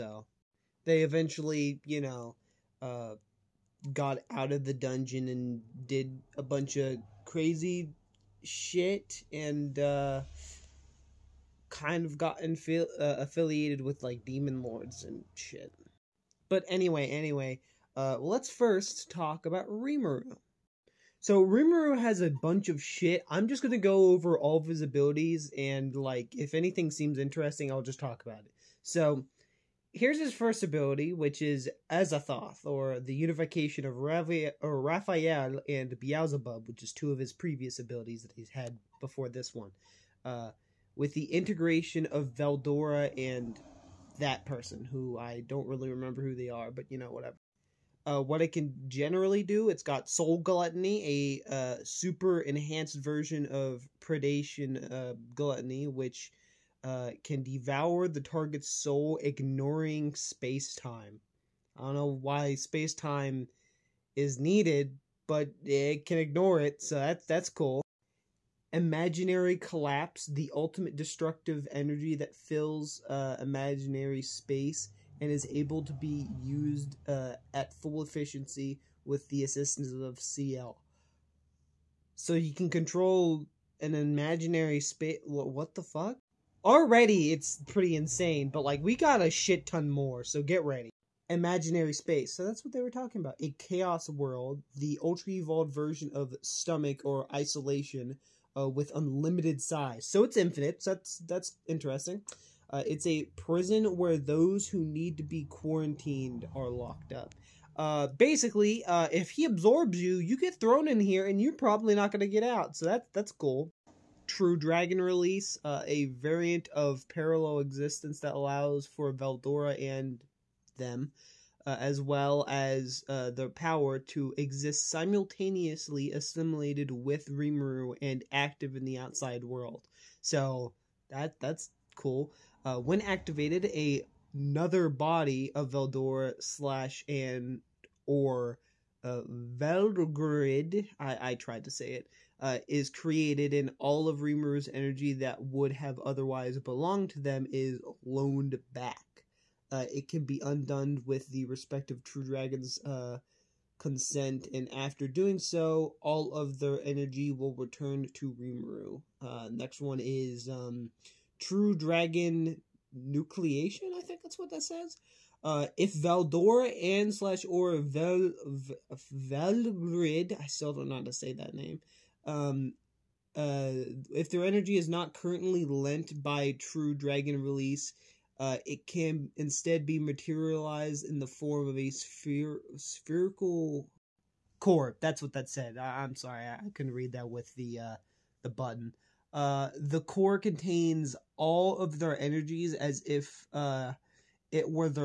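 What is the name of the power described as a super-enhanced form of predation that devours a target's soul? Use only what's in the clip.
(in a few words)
Soul Gluttony.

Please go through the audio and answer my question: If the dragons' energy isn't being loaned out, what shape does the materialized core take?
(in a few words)
A sphere.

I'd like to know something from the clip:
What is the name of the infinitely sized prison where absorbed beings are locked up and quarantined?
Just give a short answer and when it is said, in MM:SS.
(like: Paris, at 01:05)
Chaos World, at 01:33.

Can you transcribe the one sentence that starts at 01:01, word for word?
I don't know why space time is needed, but it can ignore it, so that's that's cool.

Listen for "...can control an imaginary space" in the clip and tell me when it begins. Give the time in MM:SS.
01:22.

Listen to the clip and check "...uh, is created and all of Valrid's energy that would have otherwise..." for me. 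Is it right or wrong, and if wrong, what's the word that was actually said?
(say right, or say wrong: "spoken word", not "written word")
wrong: "Rimuru", not "Valrid".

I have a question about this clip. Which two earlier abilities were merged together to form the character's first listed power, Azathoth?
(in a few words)
Raphael and Beelzebub.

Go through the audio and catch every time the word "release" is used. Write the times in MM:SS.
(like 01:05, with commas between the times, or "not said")
01:54, 02:57.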